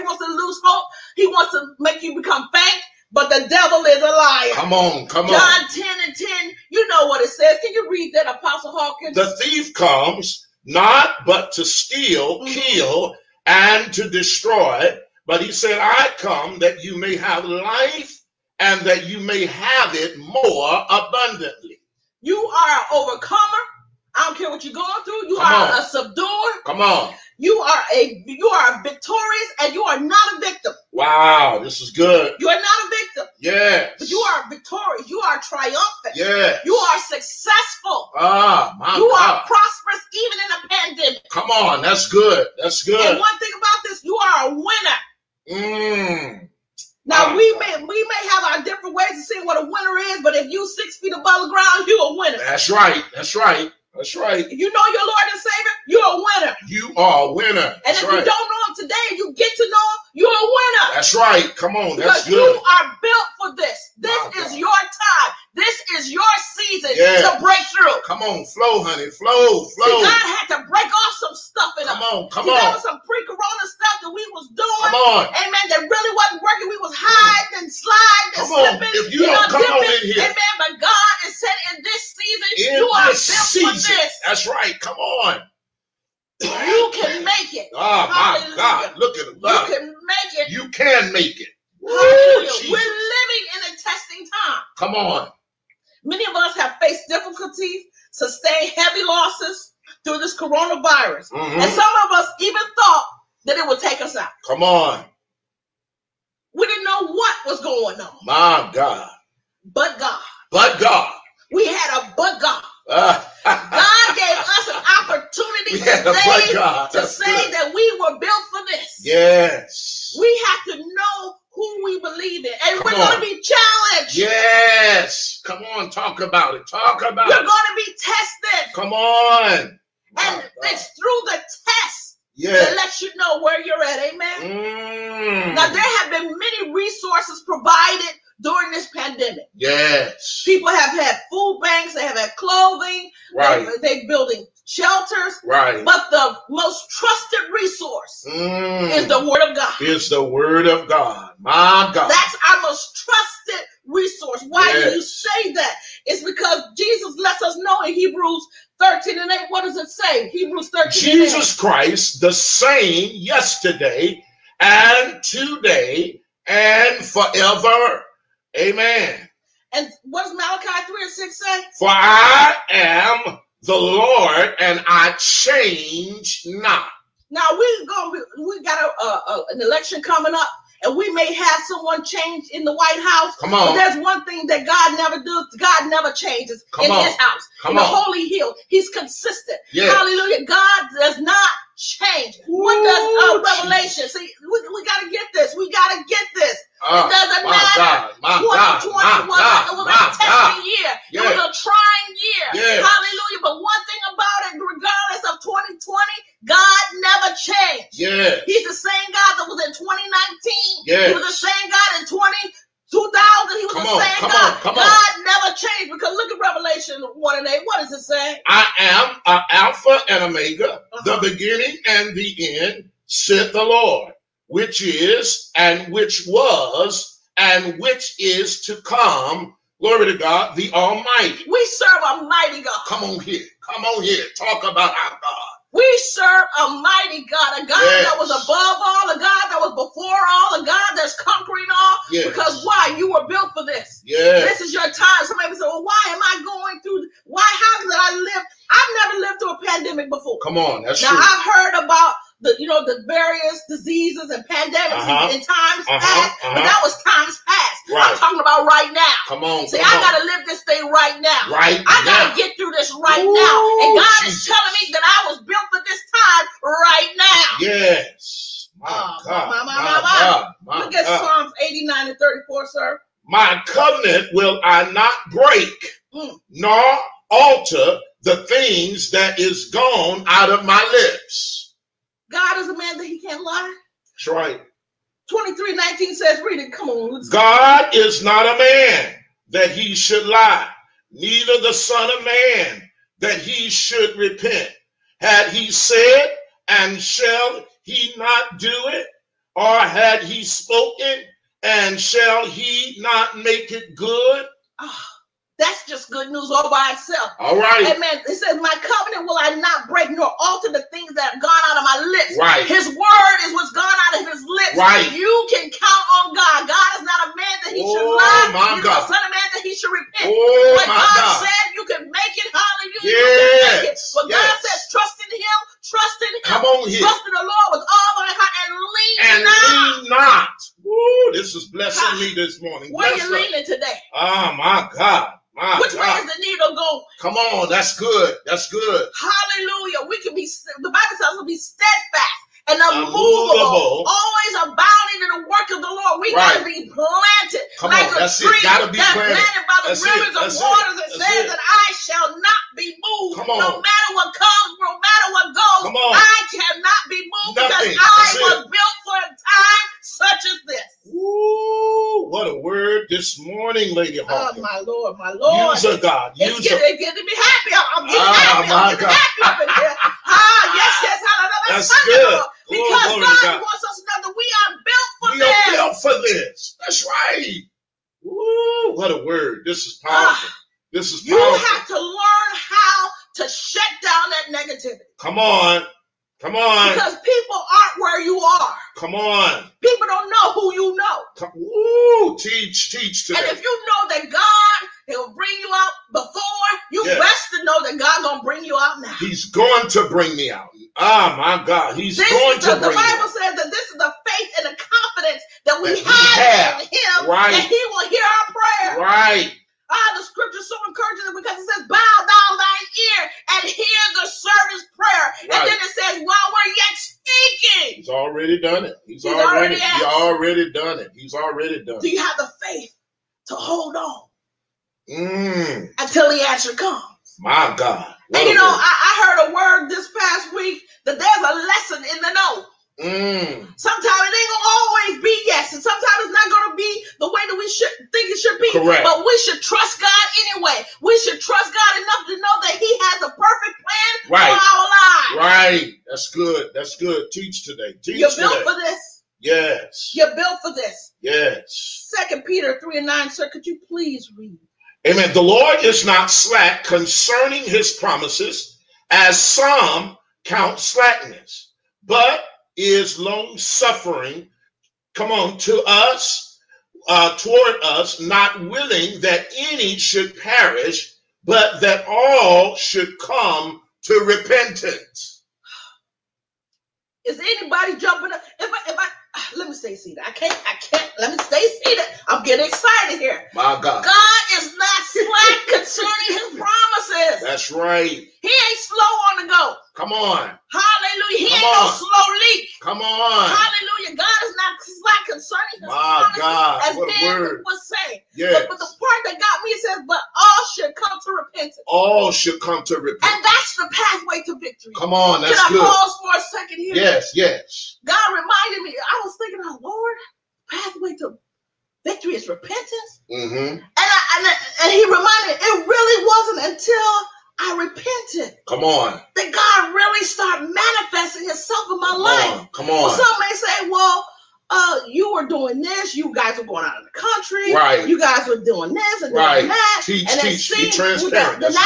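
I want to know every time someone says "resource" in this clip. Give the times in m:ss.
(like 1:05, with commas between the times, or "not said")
2:16, 2:27, 2:33.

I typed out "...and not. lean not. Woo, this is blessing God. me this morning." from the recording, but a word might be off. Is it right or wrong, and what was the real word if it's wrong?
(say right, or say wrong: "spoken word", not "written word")
right.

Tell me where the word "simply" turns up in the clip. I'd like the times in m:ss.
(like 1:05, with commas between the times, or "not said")
not said.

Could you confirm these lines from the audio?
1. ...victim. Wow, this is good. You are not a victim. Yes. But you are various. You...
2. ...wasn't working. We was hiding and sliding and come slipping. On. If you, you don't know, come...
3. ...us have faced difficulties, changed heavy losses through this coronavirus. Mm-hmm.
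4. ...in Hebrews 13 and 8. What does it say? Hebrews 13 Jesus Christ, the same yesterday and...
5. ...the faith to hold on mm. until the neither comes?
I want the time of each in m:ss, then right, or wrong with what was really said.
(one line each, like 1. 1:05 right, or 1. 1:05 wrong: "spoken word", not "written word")
1. 0:30 wrong: "victorious", not "various"
2. 1:16 right
3. 1:36 wrong: "sustained", not "changed"
4. 2:37 right
5. 7:02 wrong: "answer", not "neither".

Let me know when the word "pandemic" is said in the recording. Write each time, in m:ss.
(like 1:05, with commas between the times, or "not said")
0:41, 2:18, 4:09, 4:14.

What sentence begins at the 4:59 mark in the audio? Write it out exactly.
or had he spoken, and shall he not make it good?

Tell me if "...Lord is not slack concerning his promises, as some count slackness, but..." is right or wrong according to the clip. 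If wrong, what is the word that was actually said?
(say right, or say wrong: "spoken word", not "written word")
right.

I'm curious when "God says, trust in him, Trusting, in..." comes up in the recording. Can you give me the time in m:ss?
5:24.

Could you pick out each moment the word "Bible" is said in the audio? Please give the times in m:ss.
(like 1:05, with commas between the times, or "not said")
5:40, 6:42.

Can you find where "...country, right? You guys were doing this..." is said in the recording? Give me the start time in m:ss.
8:47.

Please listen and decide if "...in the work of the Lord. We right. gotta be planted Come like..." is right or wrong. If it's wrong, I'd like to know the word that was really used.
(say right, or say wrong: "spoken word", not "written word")
right.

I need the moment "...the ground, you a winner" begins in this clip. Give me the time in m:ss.
0:51.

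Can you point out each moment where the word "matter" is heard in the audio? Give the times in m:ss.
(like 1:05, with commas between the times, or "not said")
3:17, 5:53.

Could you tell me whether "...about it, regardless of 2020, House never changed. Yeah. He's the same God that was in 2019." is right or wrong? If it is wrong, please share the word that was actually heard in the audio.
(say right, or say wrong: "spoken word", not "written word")
wrong: "God", not "House".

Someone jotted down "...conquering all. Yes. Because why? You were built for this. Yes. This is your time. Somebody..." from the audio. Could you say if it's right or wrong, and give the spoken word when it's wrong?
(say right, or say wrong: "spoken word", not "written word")
right.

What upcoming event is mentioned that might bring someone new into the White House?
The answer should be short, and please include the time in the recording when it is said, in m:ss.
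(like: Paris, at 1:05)
An election, at 2:59.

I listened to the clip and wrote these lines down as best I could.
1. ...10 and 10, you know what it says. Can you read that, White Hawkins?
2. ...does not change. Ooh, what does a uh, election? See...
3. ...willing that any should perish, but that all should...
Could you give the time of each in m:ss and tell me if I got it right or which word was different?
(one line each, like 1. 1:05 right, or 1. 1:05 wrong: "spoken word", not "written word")
1. 0:05 wrong: "Apostle", not "White"
2. 3:10 wrong: "revelation", not "election"
3. 7:48 right.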